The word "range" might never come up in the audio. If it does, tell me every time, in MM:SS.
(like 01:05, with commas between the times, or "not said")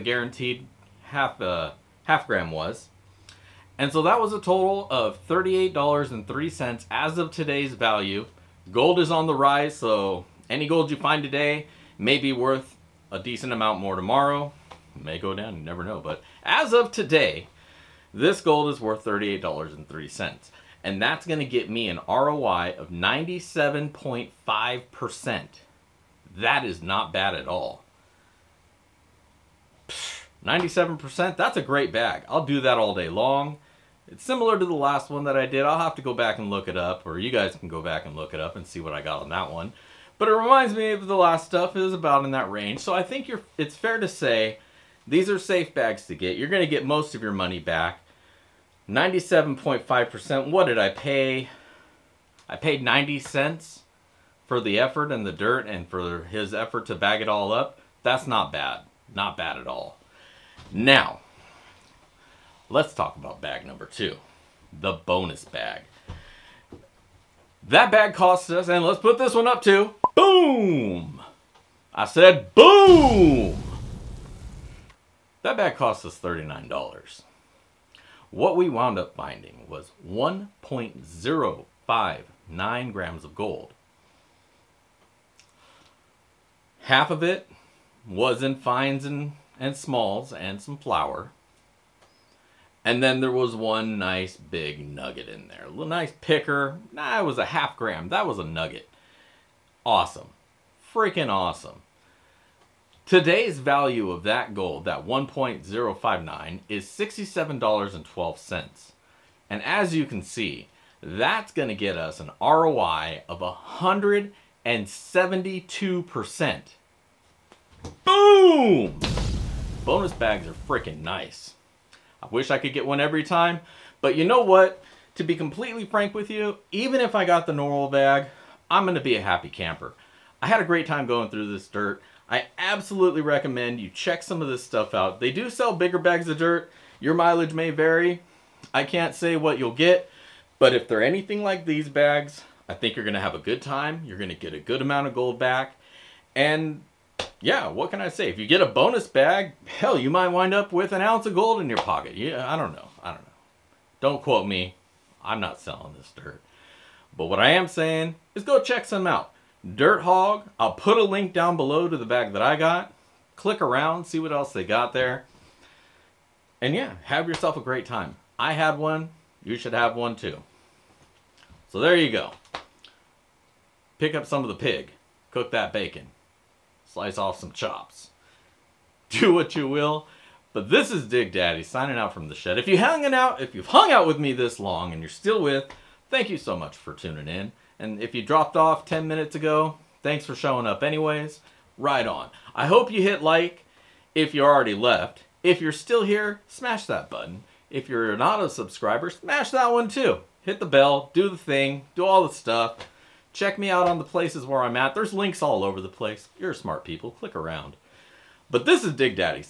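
00:42.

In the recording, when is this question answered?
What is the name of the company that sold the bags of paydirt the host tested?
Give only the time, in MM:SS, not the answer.
02:39.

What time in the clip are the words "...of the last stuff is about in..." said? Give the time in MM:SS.
00:40.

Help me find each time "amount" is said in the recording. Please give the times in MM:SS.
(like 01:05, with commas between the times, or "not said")
00:13, 02:24.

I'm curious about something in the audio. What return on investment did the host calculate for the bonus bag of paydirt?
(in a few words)
172%.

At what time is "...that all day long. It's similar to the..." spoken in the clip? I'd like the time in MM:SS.
00:32.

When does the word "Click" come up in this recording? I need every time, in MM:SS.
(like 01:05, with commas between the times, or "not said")
02:43, 03:27.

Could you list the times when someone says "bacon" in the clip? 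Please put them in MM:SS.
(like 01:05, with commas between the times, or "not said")
02:55.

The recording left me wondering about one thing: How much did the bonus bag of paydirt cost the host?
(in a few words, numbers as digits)
$39.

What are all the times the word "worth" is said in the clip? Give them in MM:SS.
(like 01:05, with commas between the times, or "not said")
00:12, 00:18.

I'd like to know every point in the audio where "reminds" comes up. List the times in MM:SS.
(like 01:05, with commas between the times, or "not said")
00:40.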